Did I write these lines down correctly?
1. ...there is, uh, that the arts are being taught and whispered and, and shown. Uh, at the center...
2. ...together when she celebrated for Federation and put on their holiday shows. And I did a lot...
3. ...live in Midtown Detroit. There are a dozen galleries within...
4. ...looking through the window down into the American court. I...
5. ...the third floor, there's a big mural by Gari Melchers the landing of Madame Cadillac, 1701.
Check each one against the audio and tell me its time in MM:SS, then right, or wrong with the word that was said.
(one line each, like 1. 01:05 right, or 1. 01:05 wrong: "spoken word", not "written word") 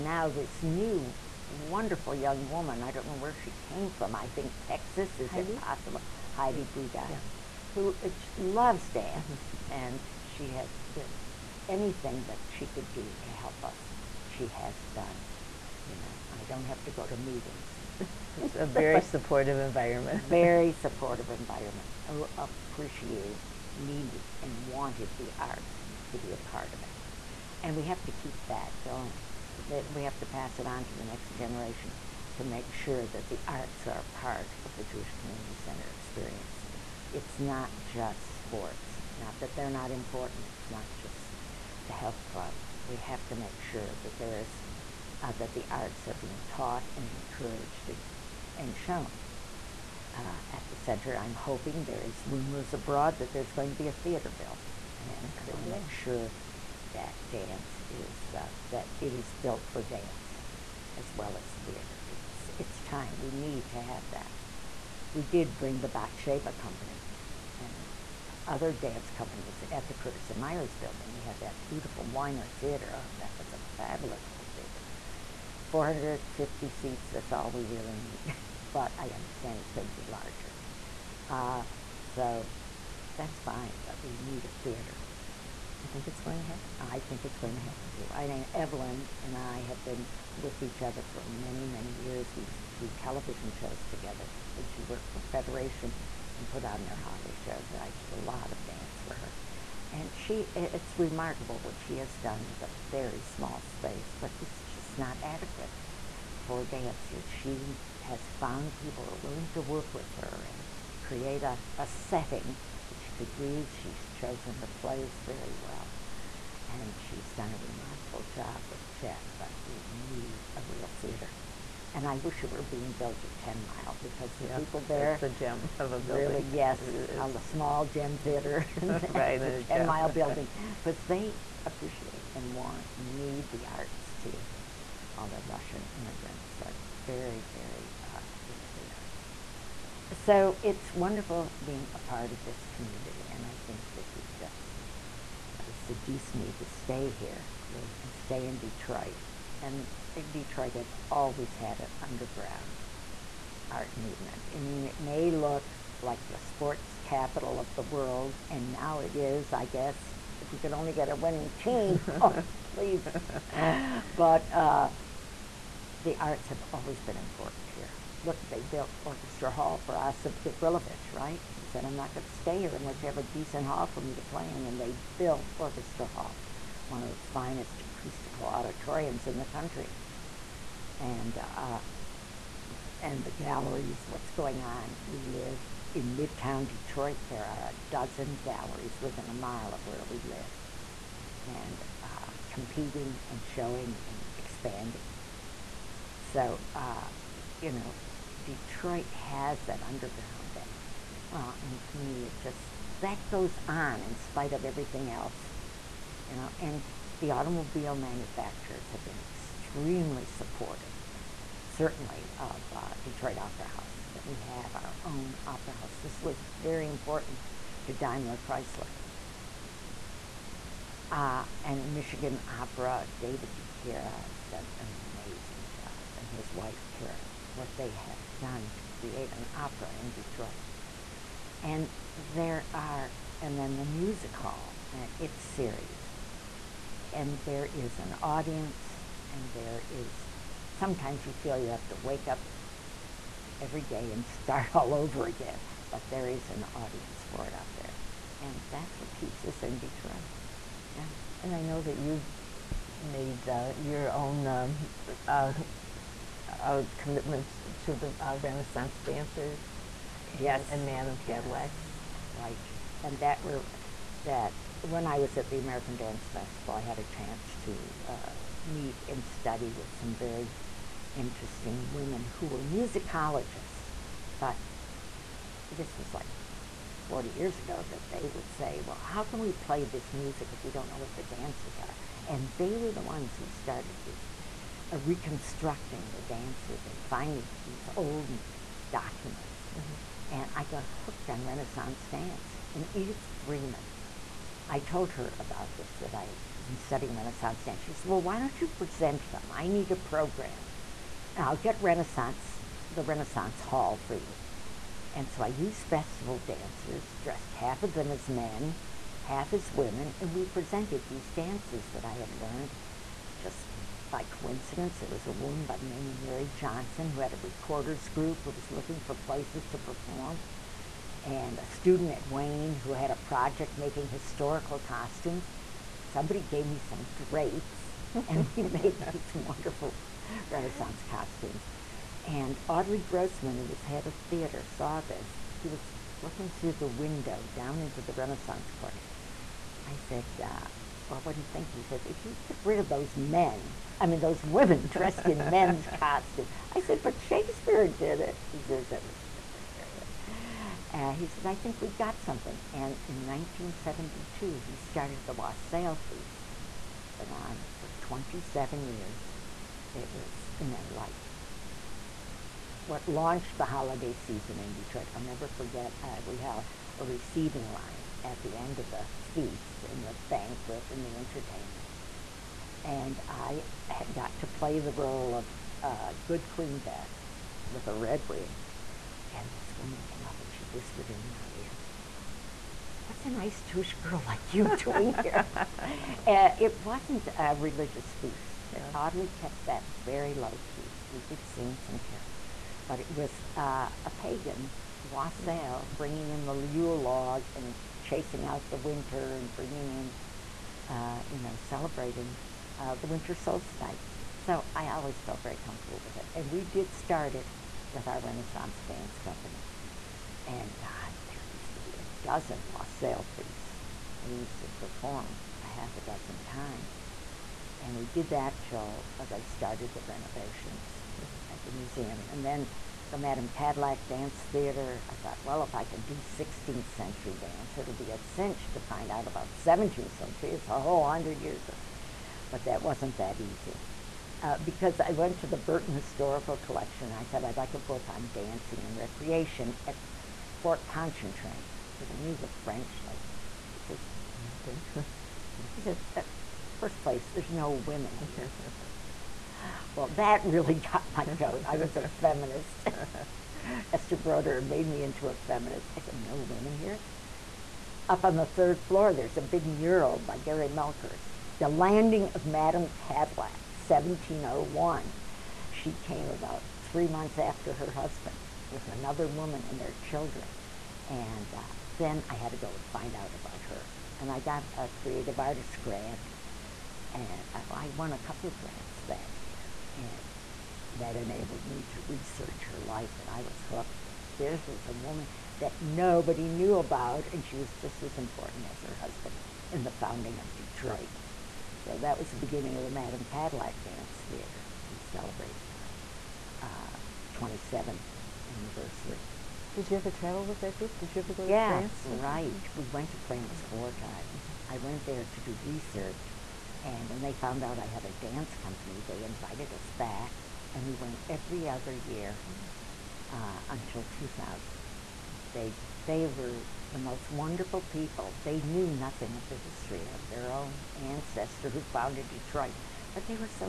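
1. 00:44 wrong: "encouraged", not "whispered"
2. 01:33 wrong: "worked", not "celebrated"
3. 03:05 right
4. 05:36 wrong: "Renaissance", not "American"
5. 07:38 right.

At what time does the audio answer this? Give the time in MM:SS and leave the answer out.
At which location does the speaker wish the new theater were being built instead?
02:03.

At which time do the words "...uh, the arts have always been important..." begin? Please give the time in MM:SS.
02:44.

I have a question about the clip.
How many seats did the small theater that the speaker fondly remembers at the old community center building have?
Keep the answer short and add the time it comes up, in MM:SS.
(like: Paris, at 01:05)
450, at 01:15.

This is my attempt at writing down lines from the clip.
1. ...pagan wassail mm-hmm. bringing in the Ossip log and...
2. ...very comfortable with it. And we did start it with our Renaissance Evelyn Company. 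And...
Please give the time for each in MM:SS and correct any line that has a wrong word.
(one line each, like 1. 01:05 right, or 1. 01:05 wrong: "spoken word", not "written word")
1. 06:34 wrong: "Yule", not "Ossip"
2. 06:45 wrong: "Dance", not "Evelyn".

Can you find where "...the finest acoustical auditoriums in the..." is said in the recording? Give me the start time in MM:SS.
02:57.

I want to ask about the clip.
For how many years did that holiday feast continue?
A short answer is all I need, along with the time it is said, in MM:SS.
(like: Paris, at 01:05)
27 years, at 05:58.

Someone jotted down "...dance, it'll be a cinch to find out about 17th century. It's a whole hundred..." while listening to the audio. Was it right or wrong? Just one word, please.
right.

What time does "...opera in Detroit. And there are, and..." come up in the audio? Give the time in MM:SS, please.
03:49.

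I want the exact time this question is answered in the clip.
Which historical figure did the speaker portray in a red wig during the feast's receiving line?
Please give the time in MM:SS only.
06:16.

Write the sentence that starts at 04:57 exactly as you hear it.
She said, Well, why don't you present them?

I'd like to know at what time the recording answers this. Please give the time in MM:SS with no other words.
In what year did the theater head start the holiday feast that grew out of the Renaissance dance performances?
05:53.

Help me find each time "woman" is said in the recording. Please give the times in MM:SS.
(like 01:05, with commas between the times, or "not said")
00:02, 05:15, 06:19, 07:49, 08:04.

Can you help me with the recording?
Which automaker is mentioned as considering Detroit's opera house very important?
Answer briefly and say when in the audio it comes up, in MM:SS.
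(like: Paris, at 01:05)
Daimler Chrysler, at 03:37.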